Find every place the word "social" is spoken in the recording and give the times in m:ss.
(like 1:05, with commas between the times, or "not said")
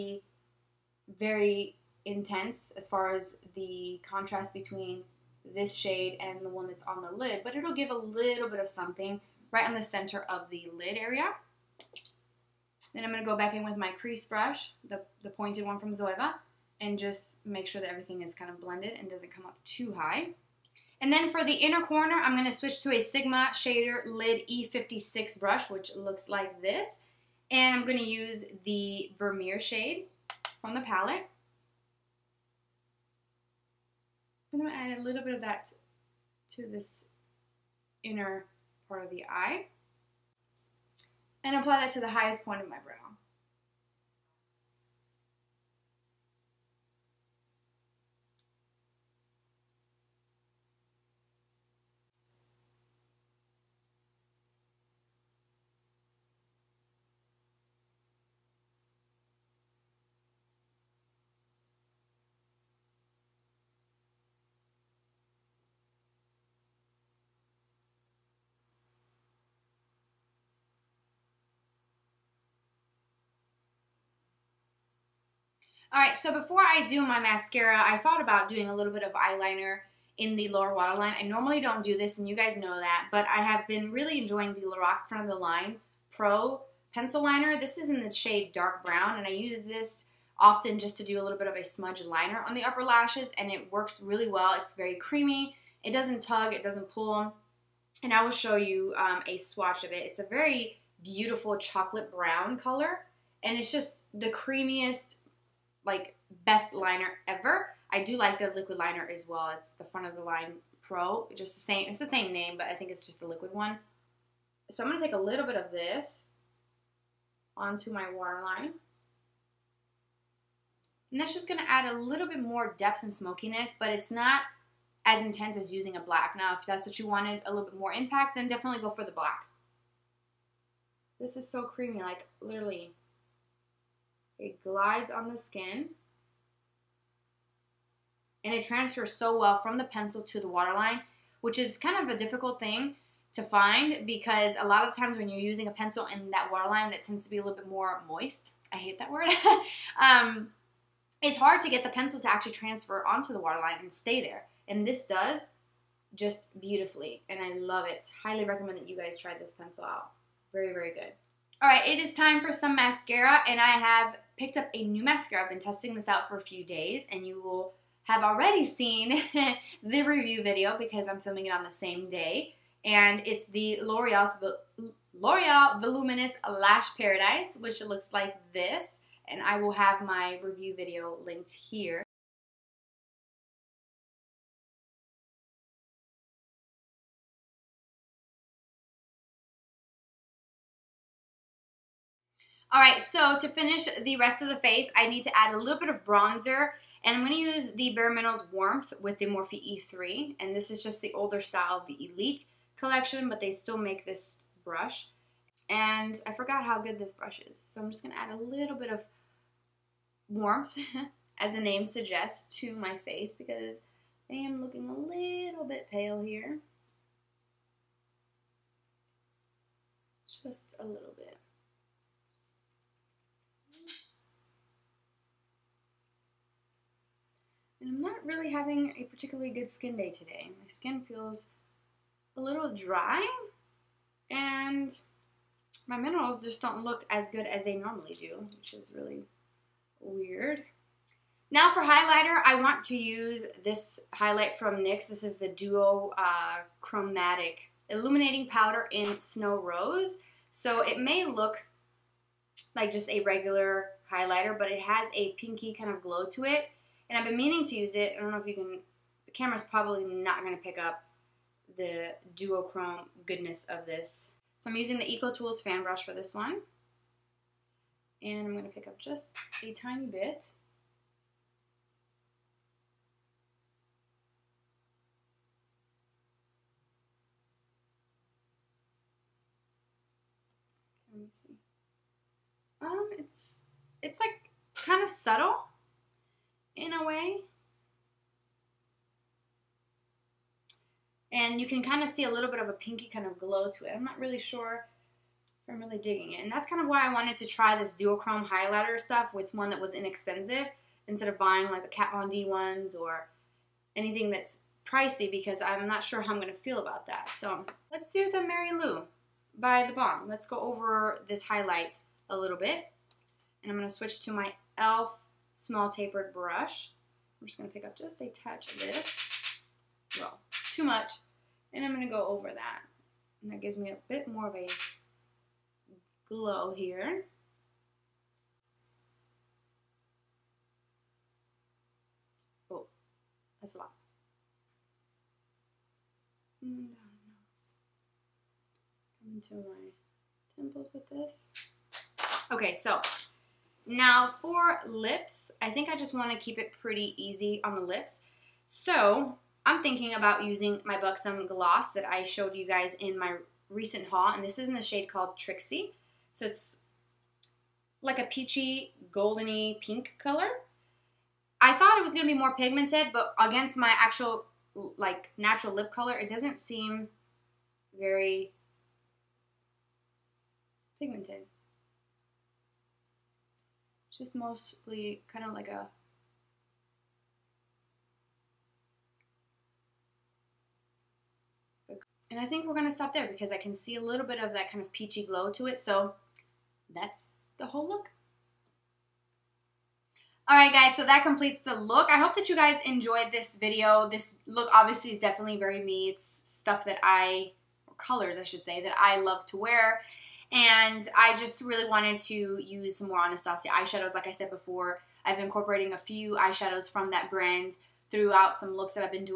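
not said.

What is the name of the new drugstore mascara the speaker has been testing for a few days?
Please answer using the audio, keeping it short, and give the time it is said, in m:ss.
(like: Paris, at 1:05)
Voluminous Lash Paradise, at 2:55.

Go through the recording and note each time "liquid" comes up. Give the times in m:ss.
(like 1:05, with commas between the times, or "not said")
1:48, 1:53.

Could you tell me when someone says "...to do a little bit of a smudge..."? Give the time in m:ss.
1:30.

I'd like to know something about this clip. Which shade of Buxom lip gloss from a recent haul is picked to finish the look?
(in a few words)
Trixie.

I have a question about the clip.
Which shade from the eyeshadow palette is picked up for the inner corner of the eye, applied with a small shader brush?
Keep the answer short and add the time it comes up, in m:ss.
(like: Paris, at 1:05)
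Vermeer, at 0:29.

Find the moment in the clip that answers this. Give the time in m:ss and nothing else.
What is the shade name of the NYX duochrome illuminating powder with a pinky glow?
4:09.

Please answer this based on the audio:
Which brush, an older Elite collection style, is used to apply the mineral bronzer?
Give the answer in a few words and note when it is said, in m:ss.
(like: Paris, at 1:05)
Morphe E3, at 3:19.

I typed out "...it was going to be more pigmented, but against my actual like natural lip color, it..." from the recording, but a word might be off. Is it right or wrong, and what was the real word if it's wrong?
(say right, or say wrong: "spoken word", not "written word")
right.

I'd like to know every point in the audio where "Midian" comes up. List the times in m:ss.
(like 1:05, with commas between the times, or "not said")
not said.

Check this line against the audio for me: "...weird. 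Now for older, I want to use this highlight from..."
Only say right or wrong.
wrong.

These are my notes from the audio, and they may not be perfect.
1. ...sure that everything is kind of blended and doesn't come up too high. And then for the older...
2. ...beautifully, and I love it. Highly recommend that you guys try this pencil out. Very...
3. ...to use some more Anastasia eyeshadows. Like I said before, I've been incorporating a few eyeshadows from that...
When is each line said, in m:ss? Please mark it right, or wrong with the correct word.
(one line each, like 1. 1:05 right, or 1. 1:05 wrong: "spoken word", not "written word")
1. 0:17 wrong: "inner", not "older"
2. 2:36 right
3. 6:42 right.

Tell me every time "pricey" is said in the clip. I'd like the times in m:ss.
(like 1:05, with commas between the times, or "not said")
5:04.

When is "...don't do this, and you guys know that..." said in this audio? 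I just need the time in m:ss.
1:21.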